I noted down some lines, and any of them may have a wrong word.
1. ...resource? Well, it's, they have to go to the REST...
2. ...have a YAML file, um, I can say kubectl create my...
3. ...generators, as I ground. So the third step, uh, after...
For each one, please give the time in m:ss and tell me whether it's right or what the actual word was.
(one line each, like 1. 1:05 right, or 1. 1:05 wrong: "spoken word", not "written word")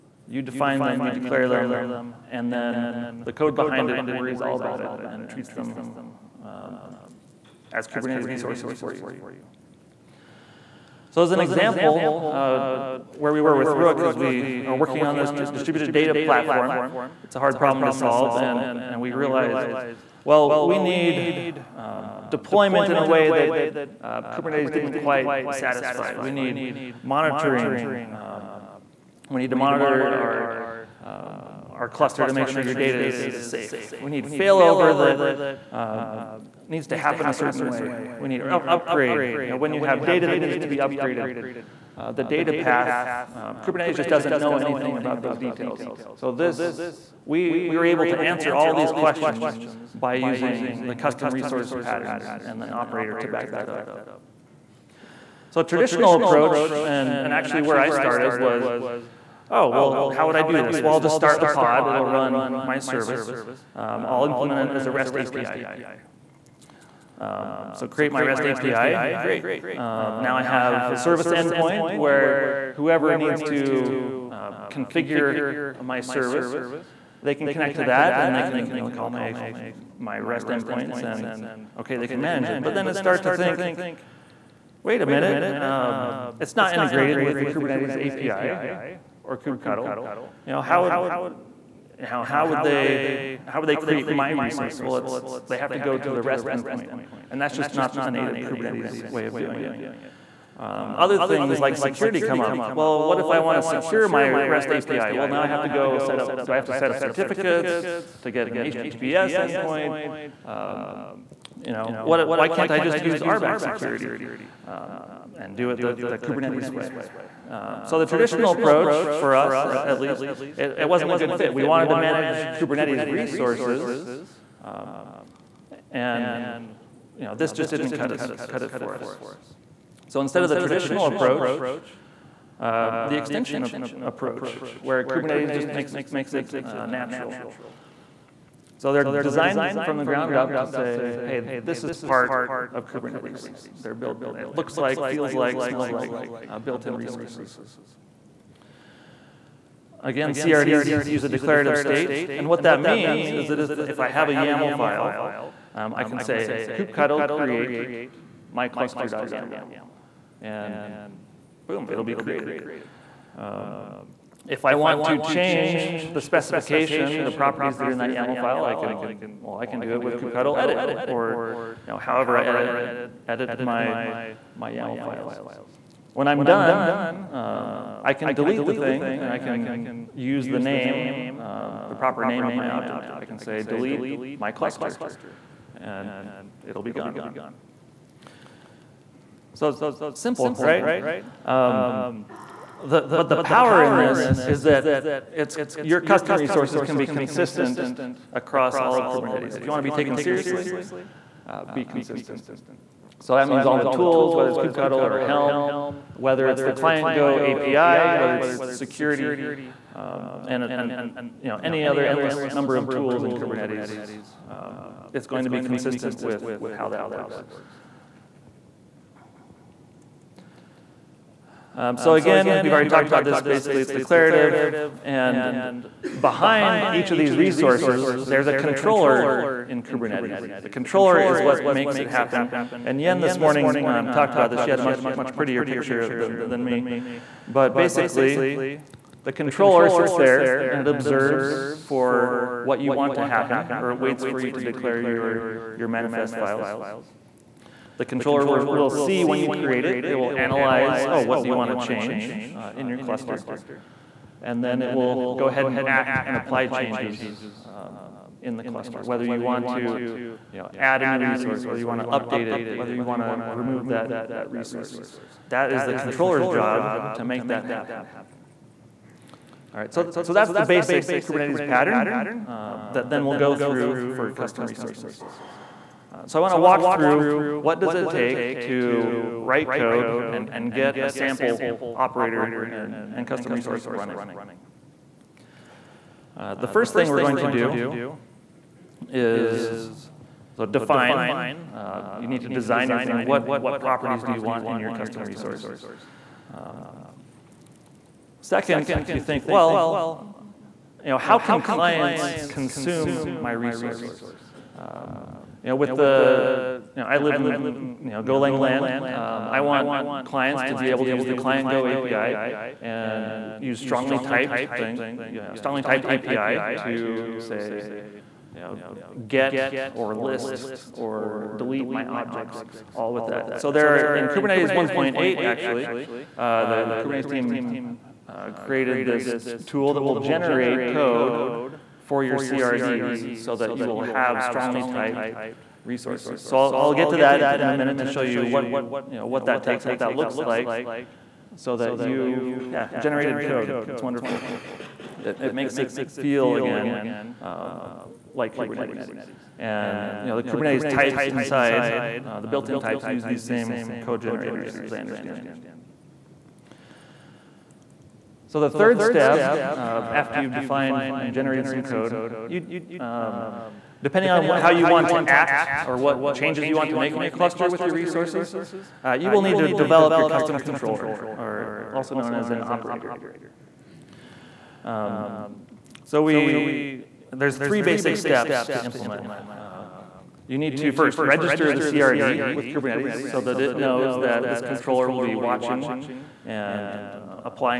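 1. 1:34 right
2. 2:34 right
3. 5:54 wrong: "understand", not "ground".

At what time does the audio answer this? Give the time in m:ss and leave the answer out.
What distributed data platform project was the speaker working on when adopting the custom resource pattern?
0:13.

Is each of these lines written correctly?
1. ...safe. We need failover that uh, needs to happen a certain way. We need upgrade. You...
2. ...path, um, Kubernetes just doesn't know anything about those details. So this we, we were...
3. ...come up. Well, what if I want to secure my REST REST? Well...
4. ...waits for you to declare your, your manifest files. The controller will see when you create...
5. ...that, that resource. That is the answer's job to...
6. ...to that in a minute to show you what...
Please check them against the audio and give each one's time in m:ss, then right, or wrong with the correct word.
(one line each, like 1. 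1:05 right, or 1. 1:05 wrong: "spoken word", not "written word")
1. 0:33 right
2. 0:42 right
3. 1:42 wrong: "API", not "REST"
4. 4:03 right
5. 4:23 wrong: "controller", not "answer"
6. 5:37 right.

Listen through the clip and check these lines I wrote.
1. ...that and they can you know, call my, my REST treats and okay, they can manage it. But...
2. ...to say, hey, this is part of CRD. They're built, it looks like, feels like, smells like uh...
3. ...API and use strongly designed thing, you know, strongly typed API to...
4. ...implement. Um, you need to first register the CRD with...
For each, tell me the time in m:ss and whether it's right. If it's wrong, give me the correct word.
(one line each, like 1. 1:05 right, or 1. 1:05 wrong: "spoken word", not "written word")
1. 1:17 wrong: "endpoints", not "treats"
2. 2:20 wrong: "Kubernetes", not "CRD"
3. 5:11 wrong: "typed", not "designed"
4. 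6:18 right.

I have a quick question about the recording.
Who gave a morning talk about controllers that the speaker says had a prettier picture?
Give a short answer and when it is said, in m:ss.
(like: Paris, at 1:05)
Yen, at 3:53.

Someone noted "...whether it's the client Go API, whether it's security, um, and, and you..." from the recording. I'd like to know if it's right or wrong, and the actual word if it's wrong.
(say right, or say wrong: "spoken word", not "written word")
right.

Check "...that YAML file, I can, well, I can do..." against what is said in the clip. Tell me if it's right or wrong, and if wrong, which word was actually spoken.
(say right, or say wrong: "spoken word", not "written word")
right.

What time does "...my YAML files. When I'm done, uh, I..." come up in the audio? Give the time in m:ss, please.
2:54.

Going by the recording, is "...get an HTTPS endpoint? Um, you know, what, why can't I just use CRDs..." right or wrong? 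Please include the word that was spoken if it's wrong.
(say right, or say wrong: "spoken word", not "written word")
wrong: "RBAC", not "CRDs".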